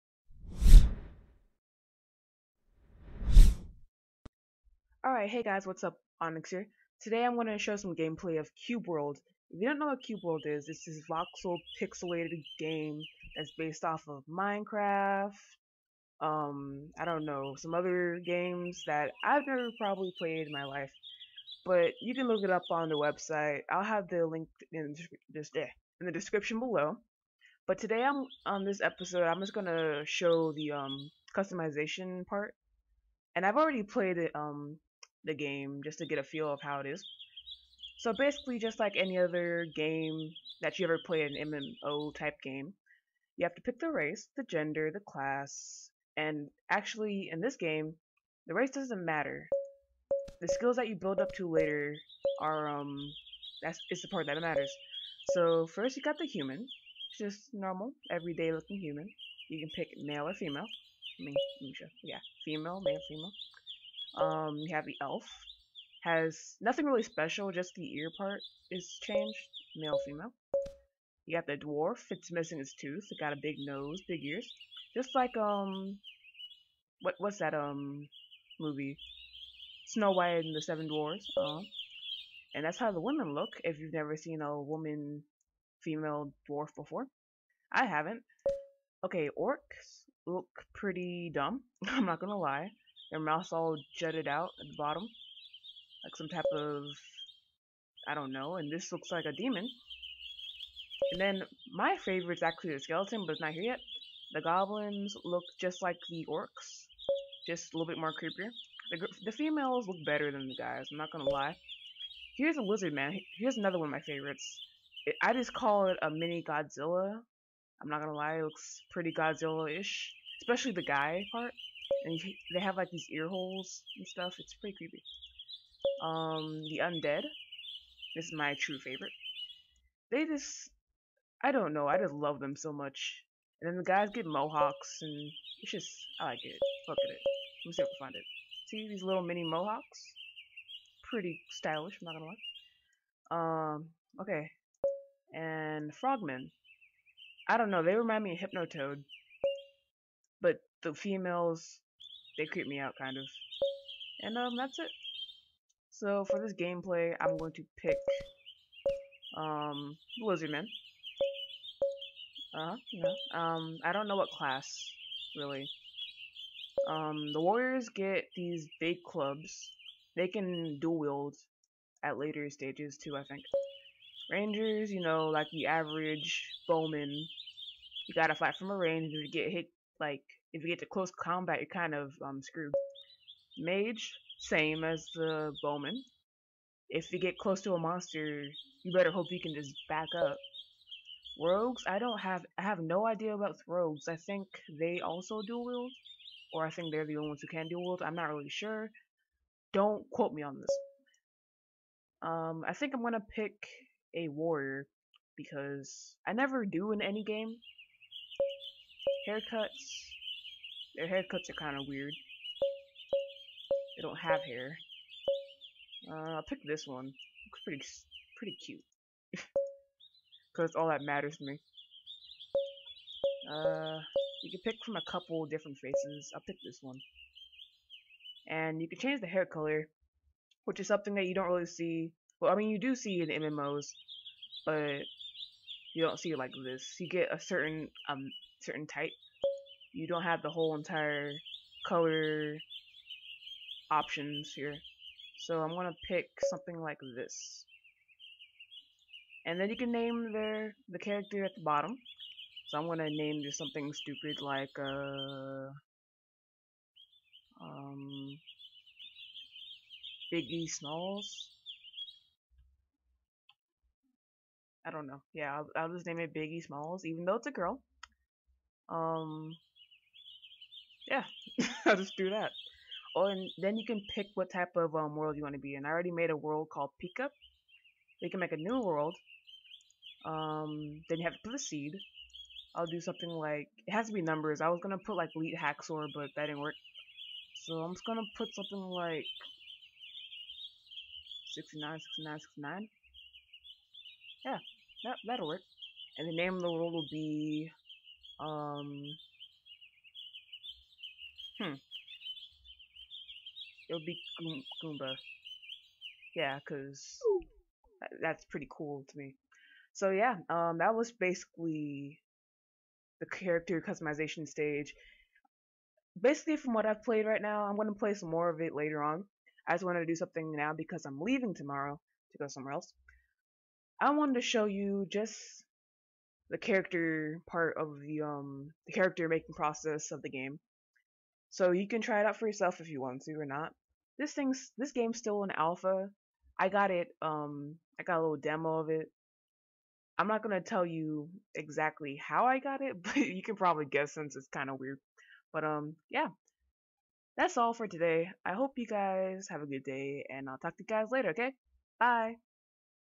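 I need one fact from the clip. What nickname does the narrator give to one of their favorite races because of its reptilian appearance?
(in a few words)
mini Godzilla.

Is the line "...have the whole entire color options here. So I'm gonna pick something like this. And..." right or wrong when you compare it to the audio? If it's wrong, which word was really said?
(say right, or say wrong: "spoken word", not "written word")
right.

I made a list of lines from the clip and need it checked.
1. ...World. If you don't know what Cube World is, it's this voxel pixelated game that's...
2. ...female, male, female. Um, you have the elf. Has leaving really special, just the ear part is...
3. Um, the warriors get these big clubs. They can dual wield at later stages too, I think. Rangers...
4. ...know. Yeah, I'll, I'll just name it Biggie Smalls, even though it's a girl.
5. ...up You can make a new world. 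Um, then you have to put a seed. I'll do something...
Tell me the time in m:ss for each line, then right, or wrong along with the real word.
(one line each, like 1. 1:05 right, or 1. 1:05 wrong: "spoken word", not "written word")
1. 0:08 right
2. 1:02 wrong: "nothing", not "leaving"
3. 2:46 right
4. 4:25 right
5. 4:37 right.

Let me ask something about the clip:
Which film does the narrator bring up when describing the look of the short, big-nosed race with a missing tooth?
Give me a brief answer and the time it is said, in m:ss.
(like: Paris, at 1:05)
Snow White and the Seven Dwarfs, at 1:19.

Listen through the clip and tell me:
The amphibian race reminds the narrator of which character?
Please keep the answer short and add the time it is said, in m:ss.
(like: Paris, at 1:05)
Hypnotoad, at 2:28.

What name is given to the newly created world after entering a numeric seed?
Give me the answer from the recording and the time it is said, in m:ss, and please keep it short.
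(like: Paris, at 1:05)
Goom Goomba, at 5:04.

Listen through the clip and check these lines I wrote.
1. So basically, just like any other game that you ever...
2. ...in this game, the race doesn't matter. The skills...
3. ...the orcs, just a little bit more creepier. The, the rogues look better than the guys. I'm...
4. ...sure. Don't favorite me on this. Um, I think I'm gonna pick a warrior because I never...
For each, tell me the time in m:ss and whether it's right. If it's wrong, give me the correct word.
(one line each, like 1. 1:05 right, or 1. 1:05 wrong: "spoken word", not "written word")
1. 0:37 right
2. 0:47 right
3. 1:46 wrong: "females", not "rogues"
4. 3:18 wrong: "quote", not "favorite".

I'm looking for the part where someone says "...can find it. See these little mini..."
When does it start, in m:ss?
2:17.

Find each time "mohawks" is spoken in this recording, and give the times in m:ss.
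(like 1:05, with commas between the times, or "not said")
2:14, 2:19.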